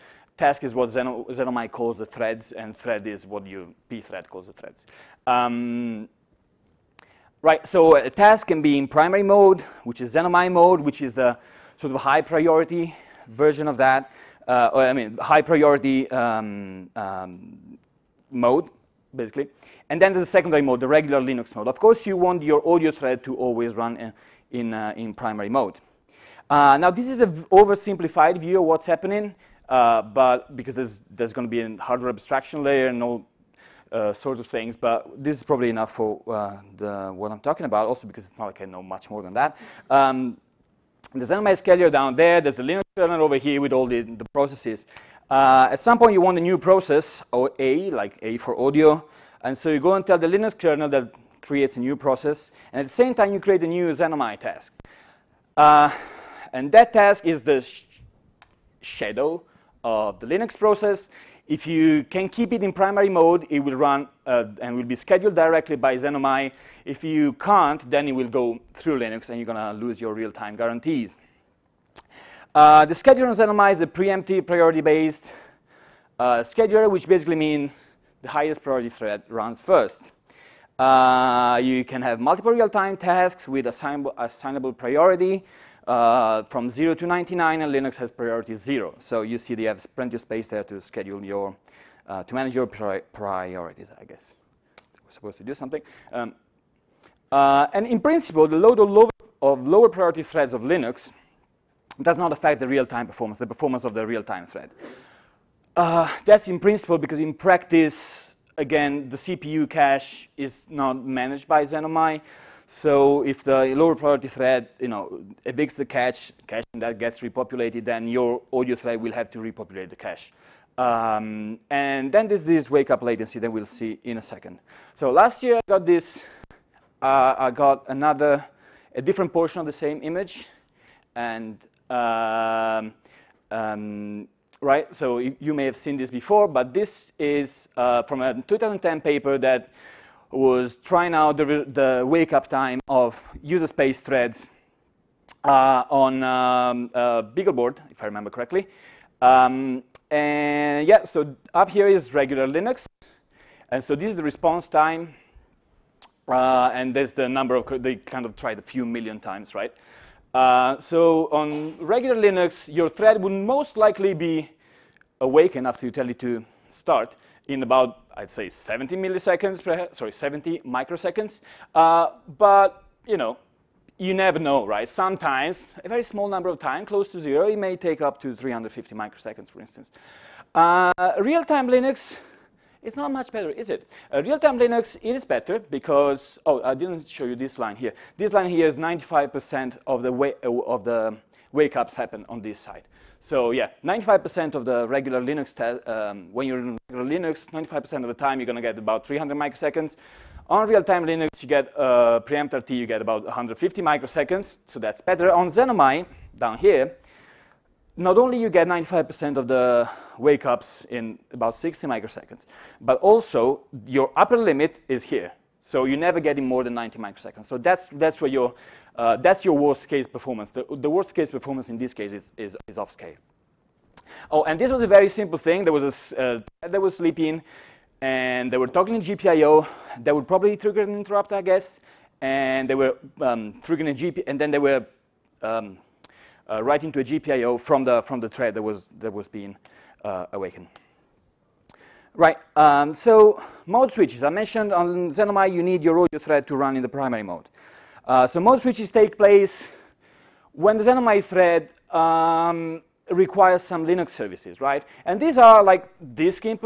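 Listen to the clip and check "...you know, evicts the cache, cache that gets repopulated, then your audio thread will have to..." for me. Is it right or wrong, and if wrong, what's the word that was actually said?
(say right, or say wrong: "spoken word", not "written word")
right.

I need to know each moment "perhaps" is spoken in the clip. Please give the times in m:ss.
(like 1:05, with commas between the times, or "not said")
2:49.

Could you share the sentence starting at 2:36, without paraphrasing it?
Uh, and there's the number of, they kind of tried a few million times, right?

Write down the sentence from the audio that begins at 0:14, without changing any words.
Uh, I mean, high priority um, um, mode, basically.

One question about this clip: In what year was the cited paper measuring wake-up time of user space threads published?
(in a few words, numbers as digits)
2010.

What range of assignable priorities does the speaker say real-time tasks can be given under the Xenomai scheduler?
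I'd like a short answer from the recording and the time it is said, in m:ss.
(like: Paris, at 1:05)
0 to 99, at 1:26.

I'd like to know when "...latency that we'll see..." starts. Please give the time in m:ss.
2:03.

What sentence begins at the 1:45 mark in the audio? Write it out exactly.
Uh, that's in principle because in practice, again, the CPU cache is not managed by Xenomai.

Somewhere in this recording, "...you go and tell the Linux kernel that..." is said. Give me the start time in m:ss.
0:49.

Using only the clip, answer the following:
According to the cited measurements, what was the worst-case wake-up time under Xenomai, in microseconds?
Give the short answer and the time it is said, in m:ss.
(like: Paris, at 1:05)
90 microseconds, at 3:36.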